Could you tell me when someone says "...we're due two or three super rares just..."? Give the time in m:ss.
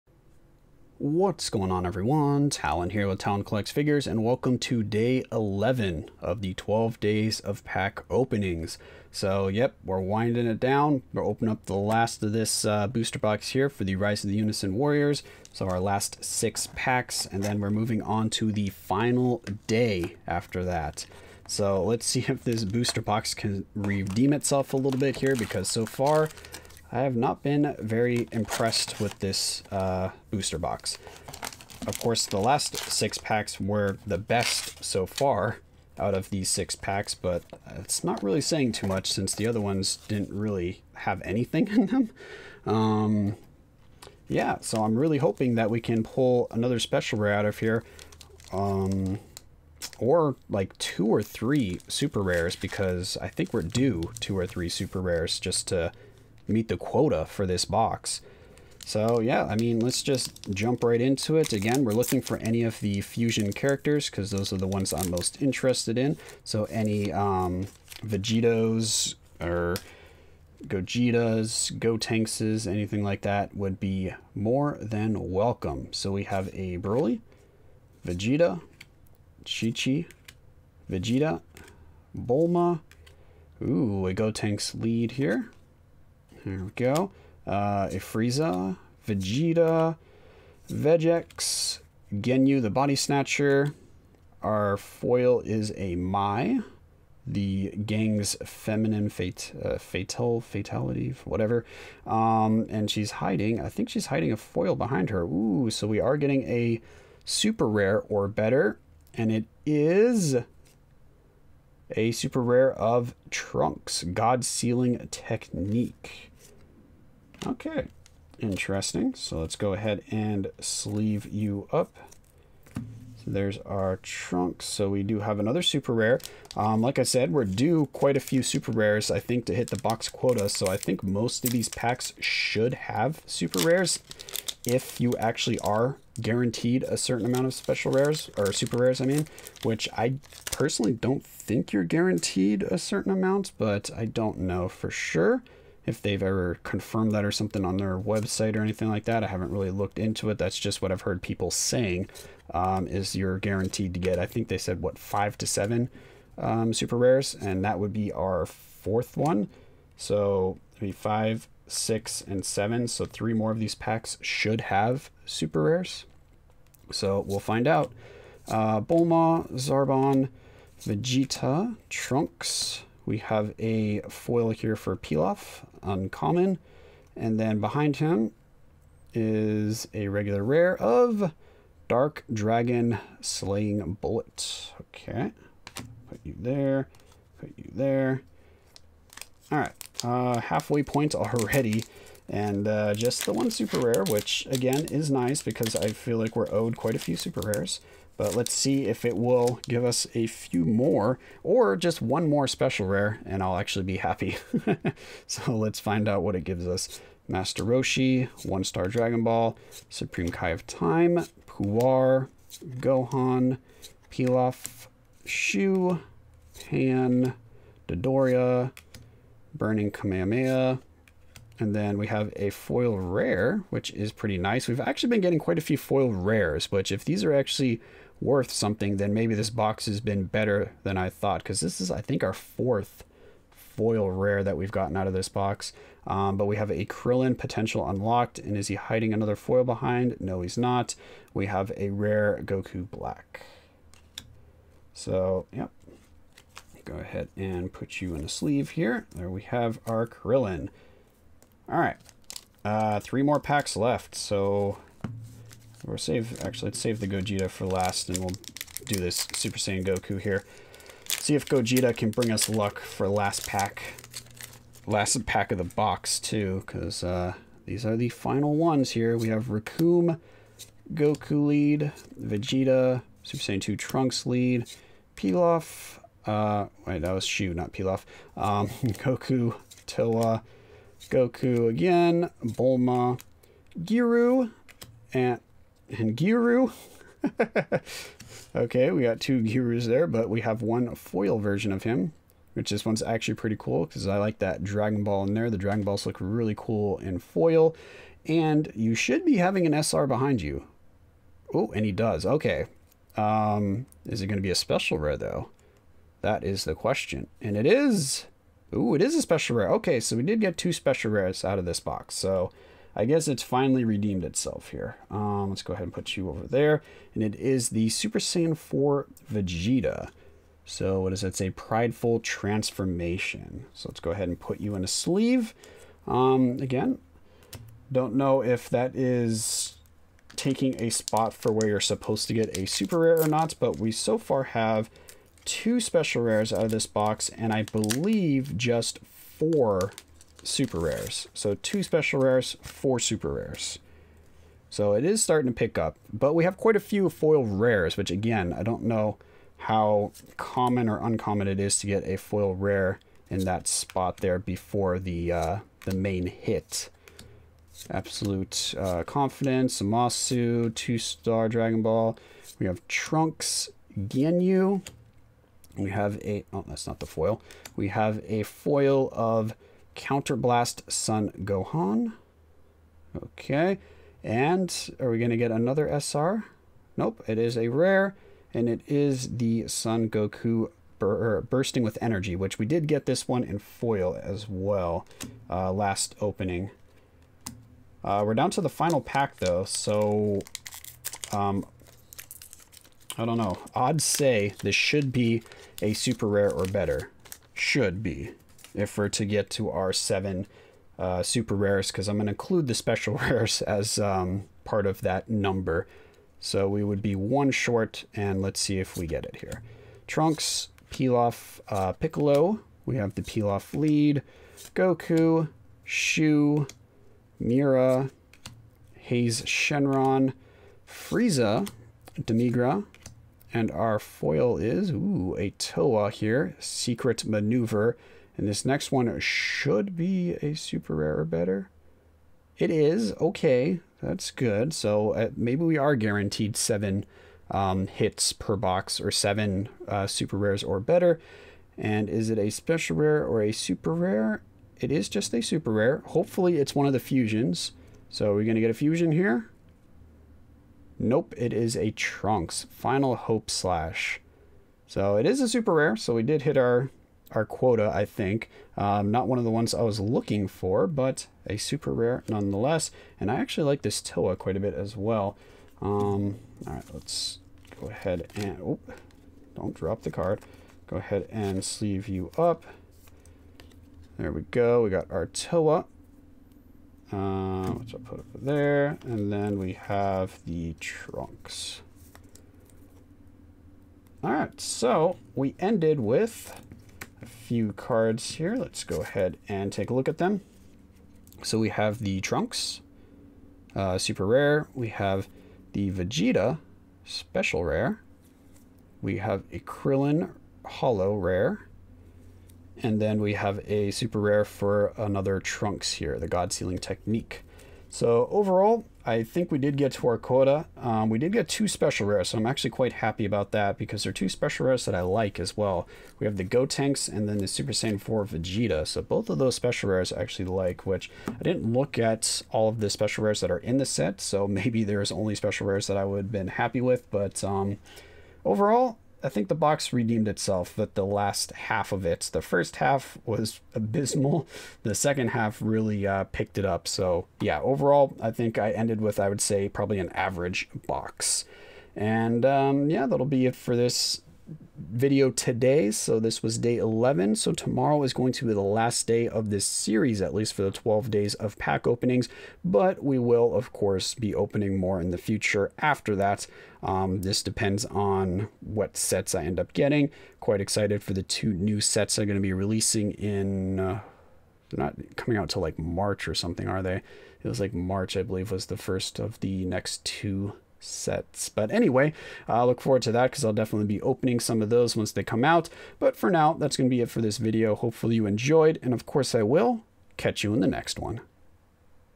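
0:53.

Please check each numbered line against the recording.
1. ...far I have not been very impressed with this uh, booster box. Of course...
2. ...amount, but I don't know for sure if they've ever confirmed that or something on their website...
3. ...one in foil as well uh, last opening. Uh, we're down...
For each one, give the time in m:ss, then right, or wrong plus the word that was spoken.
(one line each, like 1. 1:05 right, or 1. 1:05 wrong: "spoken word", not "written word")
1. 0:25 right
2. 2:23 right
3. 6:23 right.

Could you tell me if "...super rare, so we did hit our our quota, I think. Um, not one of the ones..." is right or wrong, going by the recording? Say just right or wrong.
right.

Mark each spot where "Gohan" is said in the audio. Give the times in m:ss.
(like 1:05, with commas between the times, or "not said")
3:32, 6:11.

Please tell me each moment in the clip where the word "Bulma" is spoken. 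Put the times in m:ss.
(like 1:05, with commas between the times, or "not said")
1:22, 2:48, 4:42.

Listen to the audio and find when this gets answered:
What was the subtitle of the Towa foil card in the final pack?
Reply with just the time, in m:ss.
7:06.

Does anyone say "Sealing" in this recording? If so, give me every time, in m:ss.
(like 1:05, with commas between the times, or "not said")
1:54, 8:26.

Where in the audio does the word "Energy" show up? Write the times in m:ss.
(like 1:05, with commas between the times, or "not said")
6:22.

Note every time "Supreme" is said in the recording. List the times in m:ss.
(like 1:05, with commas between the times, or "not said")
3:29.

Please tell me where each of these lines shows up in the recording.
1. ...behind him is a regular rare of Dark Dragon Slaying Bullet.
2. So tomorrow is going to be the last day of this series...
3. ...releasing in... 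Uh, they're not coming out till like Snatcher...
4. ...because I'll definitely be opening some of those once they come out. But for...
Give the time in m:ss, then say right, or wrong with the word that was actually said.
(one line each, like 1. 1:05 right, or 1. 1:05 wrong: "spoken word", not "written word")
1. 2:57 right
2. 9:07 right
3. 9:22 wrong: "March", not "Snatcher"
4. 9:33 right.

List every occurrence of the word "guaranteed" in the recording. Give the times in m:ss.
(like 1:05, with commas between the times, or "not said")
2:16, 2:21, 2:33, 7:15.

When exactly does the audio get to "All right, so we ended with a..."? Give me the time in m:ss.
8:04.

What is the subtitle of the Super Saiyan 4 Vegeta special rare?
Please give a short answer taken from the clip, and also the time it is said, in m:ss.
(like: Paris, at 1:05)
Prideful Transformation, at 5:21.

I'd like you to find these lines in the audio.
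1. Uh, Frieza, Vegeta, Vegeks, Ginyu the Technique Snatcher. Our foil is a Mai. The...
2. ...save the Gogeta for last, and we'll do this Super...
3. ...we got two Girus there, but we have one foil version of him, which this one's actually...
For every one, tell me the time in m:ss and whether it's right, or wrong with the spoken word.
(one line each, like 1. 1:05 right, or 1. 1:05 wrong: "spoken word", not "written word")
1. 1:27 wrong: "Body", not "Technique"
2. 4:16 right
3. 4:48 right.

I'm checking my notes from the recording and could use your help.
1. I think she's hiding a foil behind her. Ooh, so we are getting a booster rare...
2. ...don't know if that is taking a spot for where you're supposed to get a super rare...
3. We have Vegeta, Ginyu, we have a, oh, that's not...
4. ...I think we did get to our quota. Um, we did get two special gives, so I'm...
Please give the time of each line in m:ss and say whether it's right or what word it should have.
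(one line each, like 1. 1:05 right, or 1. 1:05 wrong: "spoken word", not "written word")
1. 1:43 wrong: "super", not "booster"
2. 5:27 right
3. 6:02 wrong: "Trunks", not "Vegeta"
4. 8:29 wrong: "rares", not "gives".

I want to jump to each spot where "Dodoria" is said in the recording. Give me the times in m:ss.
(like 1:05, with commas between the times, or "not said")
3:37.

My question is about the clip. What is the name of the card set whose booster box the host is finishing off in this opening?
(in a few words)
Rise of the Unison Warriors.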